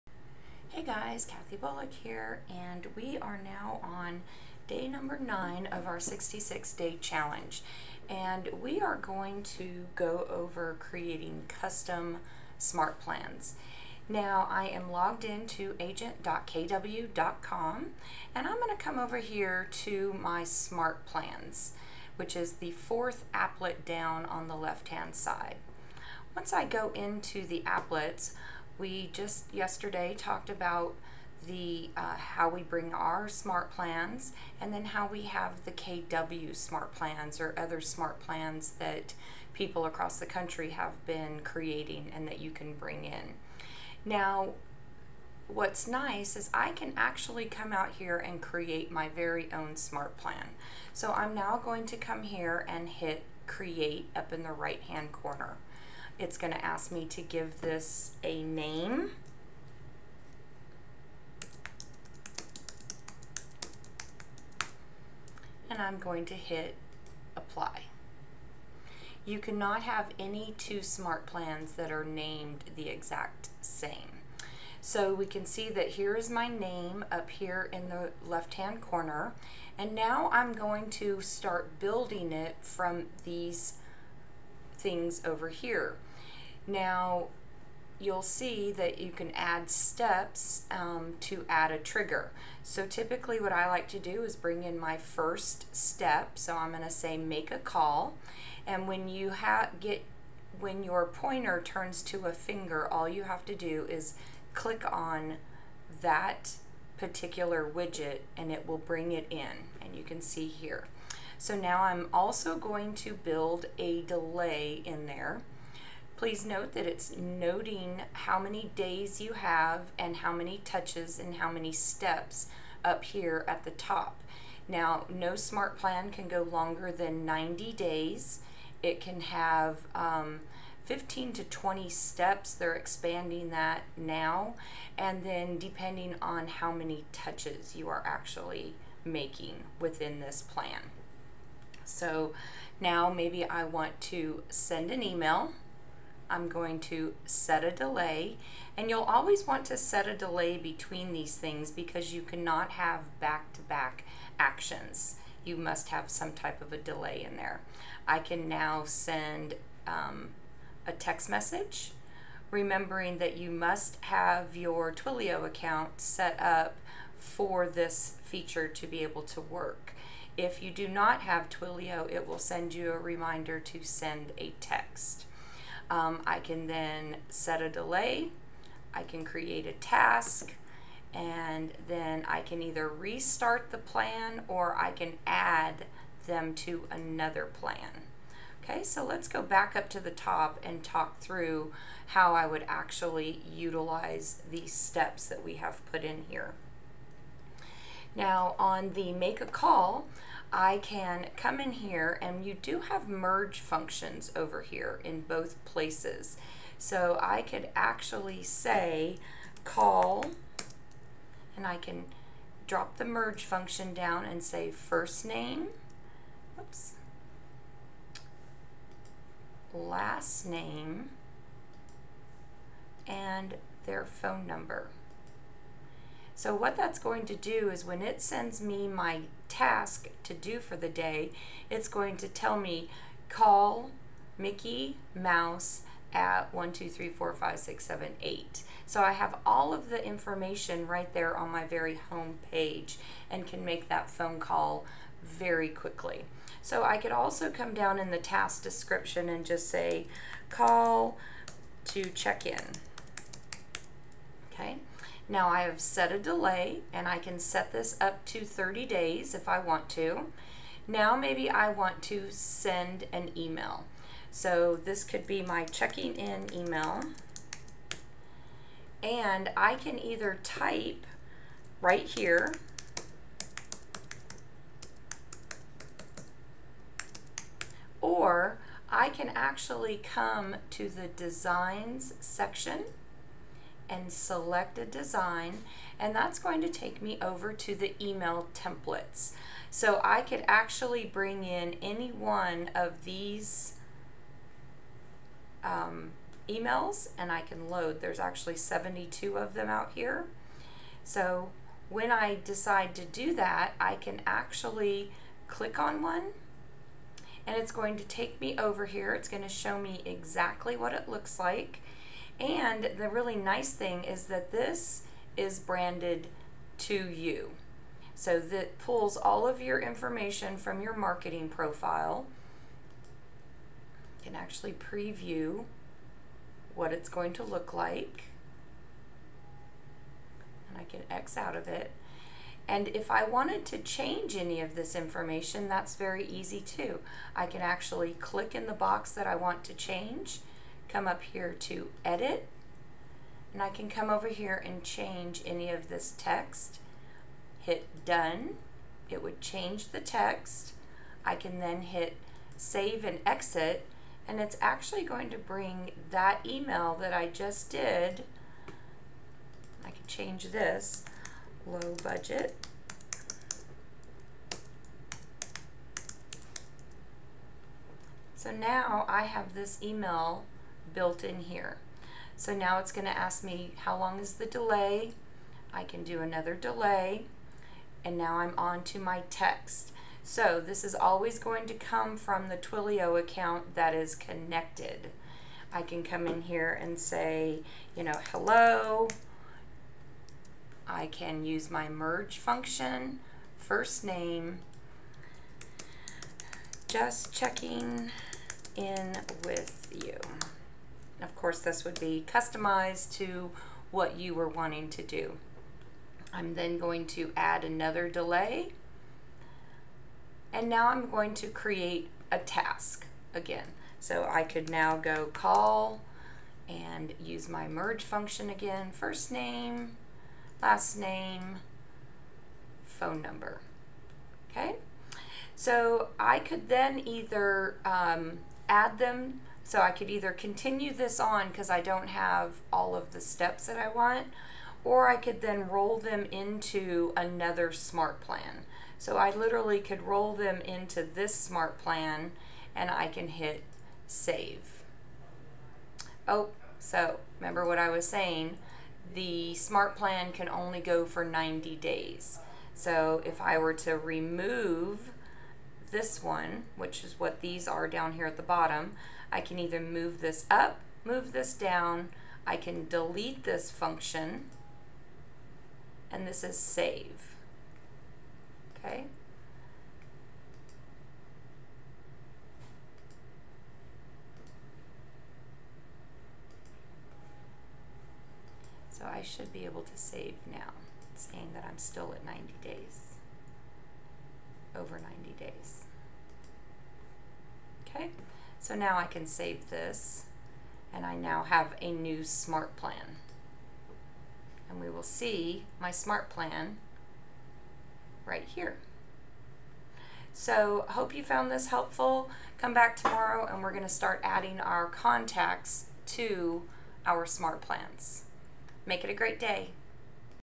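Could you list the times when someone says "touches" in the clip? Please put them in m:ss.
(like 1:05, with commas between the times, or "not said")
2:00, 2:17.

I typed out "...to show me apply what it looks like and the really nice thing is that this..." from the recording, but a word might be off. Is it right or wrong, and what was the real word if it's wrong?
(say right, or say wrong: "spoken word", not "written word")
wrong: "exactly", not "apply".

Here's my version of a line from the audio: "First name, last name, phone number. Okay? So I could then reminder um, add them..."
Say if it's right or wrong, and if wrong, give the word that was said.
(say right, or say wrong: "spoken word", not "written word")
wrong: "either", not "reminder".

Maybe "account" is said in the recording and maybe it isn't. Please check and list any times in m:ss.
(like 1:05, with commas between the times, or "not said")
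2:45, 6:23.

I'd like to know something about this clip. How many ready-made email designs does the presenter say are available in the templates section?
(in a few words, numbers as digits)
72.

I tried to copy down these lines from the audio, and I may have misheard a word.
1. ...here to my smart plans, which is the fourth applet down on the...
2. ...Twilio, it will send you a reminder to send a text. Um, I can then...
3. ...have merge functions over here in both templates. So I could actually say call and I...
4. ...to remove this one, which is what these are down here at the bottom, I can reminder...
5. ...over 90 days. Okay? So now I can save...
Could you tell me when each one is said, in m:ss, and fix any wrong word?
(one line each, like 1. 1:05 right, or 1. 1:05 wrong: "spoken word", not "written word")
1. 0:19 right
2. 2:51 right
3. 3:22 wrong: "places", not "templates"
4. 7:33 wrong: "either", not "reminder"
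5. 8:04 right.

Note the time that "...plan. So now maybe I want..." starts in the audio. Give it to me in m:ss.
2:20.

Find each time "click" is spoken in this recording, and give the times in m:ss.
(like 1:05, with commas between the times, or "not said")
1:44, 5:05, 5:38.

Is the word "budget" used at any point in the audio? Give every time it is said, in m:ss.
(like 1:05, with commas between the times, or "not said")
6:02.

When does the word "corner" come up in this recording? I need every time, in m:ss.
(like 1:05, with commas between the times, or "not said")
0:55, 1:18.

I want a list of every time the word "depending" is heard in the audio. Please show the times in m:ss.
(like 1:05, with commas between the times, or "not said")
2:15.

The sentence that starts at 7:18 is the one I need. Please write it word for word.
So I literally could roll them into this smart plan and I can hit save.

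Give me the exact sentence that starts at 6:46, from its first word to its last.
I'm then going to add another delay.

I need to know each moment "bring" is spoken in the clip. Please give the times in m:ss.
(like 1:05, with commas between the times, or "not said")
0:32, 0:42, 1:34, 1:48, 4:51, 5:55.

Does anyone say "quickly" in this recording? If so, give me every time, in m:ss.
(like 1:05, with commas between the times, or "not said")
4:05.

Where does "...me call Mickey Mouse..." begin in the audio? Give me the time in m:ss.
3:52.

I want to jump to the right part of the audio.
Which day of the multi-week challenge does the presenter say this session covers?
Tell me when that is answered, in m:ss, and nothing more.
0:04.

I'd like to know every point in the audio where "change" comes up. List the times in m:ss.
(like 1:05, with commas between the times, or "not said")
5:33, 5:39, 5:44, 5:49, 6:00.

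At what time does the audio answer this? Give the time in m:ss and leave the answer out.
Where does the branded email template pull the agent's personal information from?
5:20.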